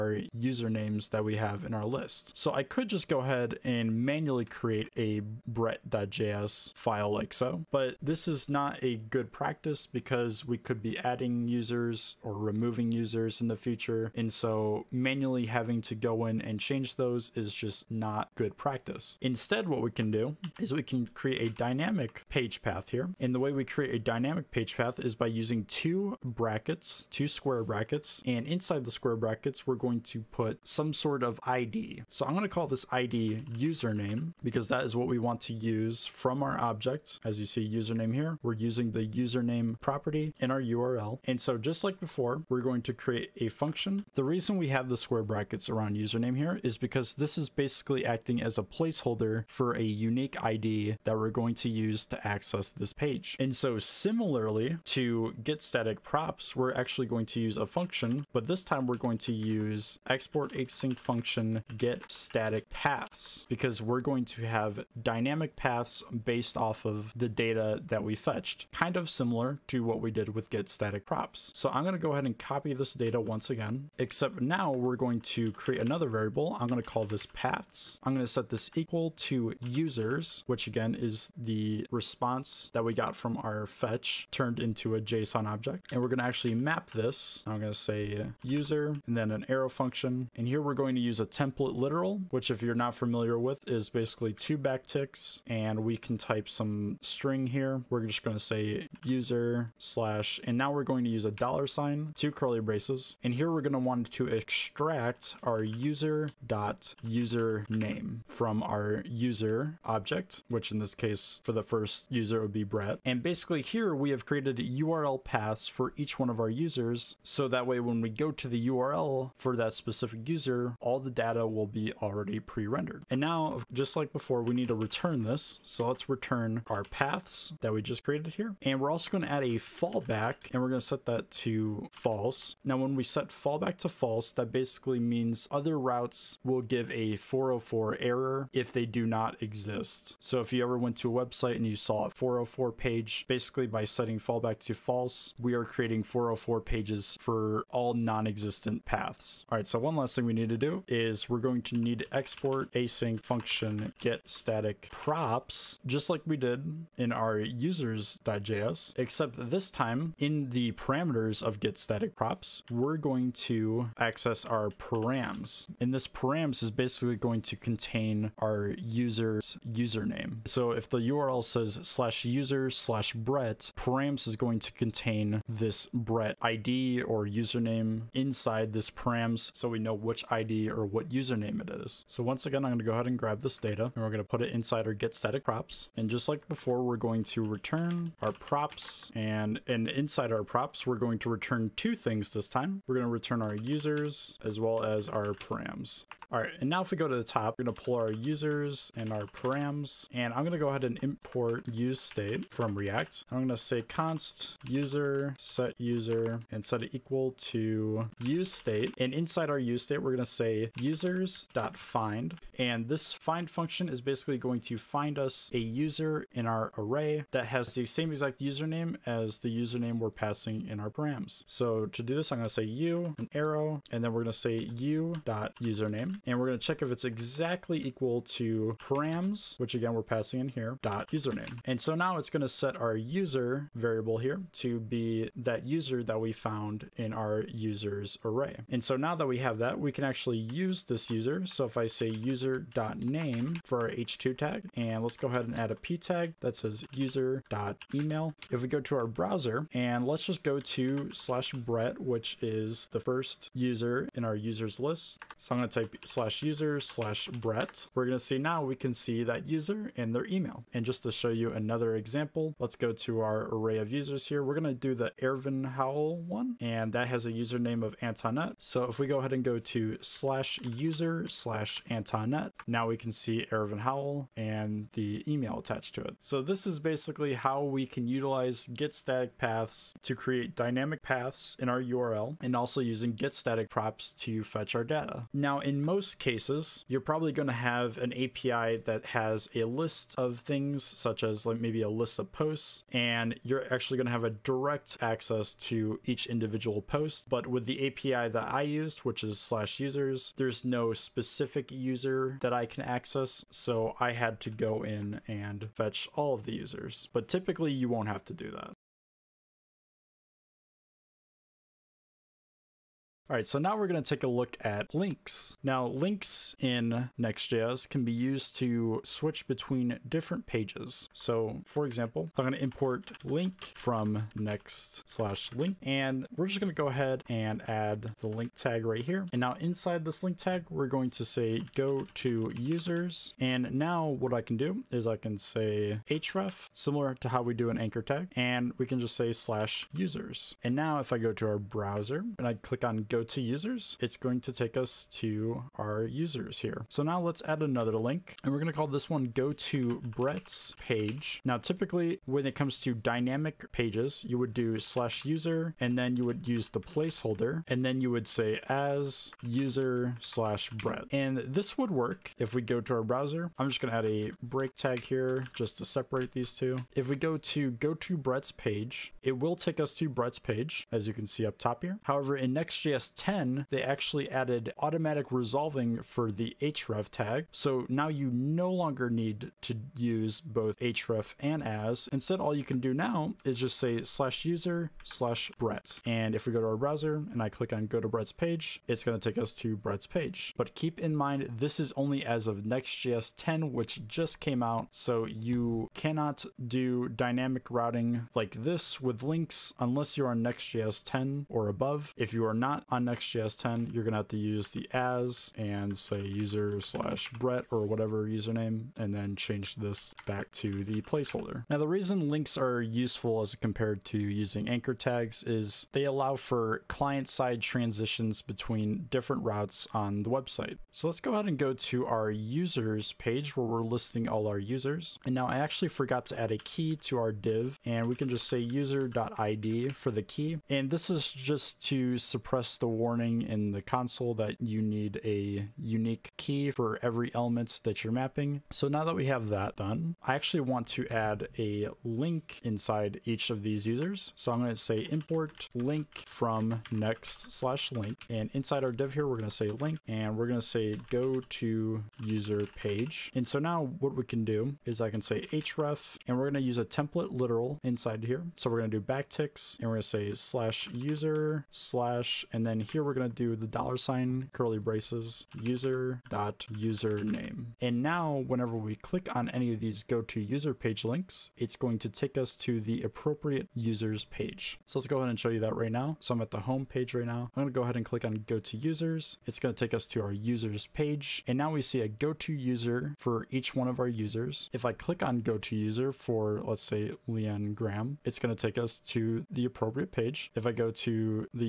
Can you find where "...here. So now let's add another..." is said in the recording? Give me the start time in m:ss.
5:46.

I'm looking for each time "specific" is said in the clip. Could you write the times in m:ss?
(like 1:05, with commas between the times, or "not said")
1:59, 5:00.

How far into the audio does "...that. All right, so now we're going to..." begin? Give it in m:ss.
5:08.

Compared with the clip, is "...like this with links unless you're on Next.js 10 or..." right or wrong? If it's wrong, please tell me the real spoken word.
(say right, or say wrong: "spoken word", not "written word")
right.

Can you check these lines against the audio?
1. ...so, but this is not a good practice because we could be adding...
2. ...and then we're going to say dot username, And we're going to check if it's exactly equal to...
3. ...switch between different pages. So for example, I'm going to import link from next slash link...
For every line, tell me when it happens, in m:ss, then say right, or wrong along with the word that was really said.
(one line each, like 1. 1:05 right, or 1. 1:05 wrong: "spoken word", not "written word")
1. 0:07 right
2. 3:43 right
3. 5:19 right.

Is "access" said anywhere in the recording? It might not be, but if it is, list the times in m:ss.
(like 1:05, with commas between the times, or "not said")
0:52, 2:43, 4:55, 5:02.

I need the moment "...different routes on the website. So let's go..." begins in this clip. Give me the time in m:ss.
6:59.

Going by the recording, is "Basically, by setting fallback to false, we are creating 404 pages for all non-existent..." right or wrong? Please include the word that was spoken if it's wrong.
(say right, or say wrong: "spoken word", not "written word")
right.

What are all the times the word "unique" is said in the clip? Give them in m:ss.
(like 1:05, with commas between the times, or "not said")
0:49, 7:15.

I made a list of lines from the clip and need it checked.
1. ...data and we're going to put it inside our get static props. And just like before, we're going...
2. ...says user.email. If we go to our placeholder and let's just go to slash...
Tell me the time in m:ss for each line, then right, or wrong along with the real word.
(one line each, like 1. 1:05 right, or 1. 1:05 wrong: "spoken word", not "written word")
1. 3:03 right
2. 4:06 wrong: "browser", not "placeholder".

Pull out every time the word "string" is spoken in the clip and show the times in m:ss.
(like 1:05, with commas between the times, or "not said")
1:37.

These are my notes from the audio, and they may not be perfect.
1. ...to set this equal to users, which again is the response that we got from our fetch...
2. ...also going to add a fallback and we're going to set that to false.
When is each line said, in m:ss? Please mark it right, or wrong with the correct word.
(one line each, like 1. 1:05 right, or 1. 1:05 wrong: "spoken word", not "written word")
1. 1:18 right
2. 2:08 right.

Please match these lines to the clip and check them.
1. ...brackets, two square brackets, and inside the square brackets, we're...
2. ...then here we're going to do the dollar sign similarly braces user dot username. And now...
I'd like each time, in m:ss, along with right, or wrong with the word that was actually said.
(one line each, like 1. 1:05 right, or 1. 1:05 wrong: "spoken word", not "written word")
1. 0:26 right
2. 7:42 wrong: "curly", not "similarly".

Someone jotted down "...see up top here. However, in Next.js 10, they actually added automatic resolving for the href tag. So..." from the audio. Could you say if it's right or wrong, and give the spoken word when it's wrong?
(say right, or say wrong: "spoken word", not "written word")
right.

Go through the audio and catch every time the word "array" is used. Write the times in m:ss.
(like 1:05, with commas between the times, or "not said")
3:36, 3:58, 4:23.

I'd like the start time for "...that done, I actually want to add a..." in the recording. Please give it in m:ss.
7:19.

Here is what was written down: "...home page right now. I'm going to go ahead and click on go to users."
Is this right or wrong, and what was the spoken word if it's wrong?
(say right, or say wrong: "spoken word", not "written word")
right.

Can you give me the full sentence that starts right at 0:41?
And so just like before, we're going to create a function.